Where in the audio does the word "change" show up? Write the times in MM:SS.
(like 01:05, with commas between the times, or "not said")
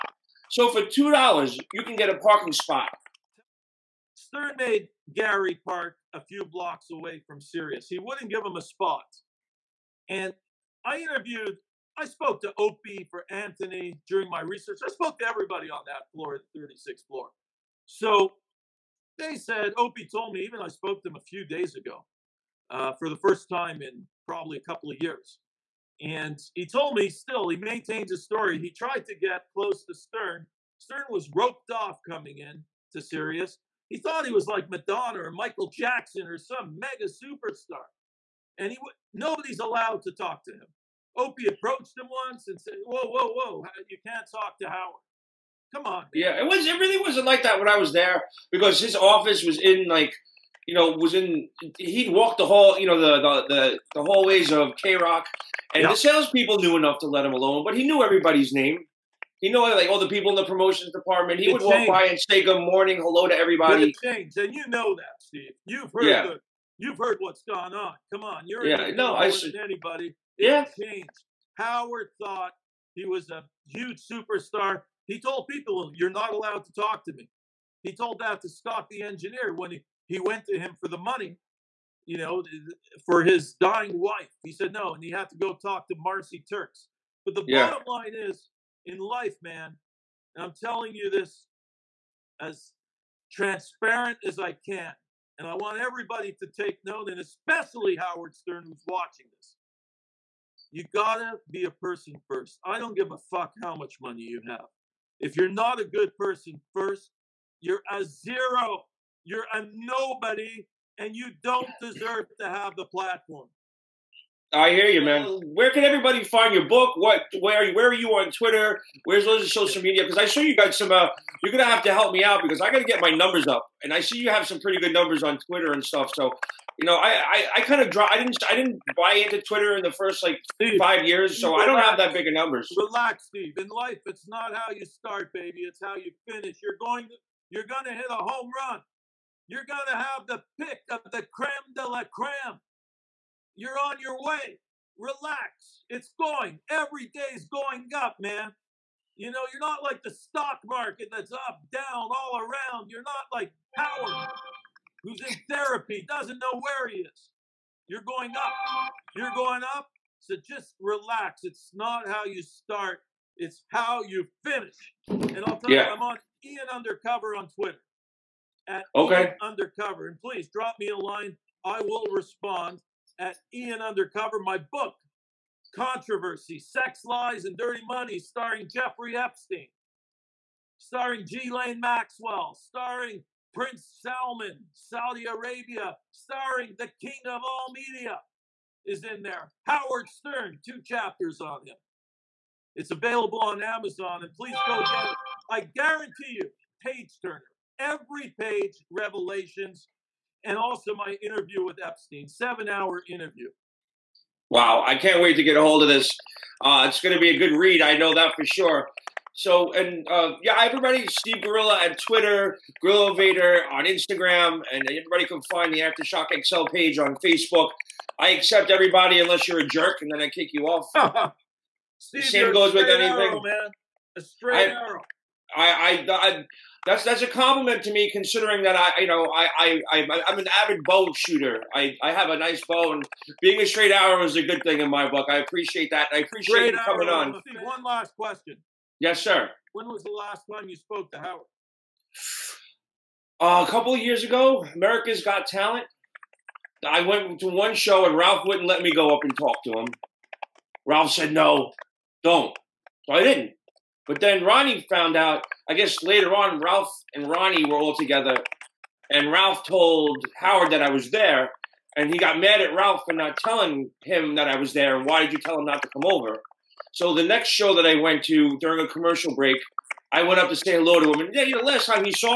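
01:04, 01:10.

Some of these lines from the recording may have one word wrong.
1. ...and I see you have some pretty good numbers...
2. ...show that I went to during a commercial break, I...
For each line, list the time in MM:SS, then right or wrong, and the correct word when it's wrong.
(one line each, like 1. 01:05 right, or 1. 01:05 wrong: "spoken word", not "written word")
1. 02:03 right
2. 04:27 right.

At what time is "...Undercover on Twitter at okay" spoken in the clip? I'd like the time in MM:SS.
02:46.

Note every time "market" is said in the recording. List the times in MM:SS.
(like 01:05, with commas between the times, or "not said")
02:30.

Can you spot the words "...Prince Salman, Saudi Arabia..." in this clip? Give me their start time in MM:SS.
03:03.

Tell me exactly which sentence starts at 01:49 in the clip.
You're a nobody and you don't deserve to have the platform.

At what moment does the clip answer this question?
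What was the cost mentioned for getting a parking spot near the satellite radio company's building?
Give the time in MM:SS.
00:00.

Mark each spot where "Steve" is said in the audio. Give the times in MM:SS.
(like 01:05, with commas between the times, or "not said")
01:05, 02:13, 03:31, 03:41.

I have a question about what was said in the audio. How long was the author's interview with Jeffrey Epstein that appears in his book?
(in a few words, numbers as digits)
7 hours.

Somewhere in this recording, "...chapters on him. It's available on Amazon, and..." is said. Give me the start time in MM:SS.
03:10.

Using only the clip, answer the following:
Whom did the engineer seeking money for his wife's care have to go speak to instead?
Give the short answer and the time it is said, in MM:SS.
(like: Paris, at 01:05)
Marci Turks, at 01:25.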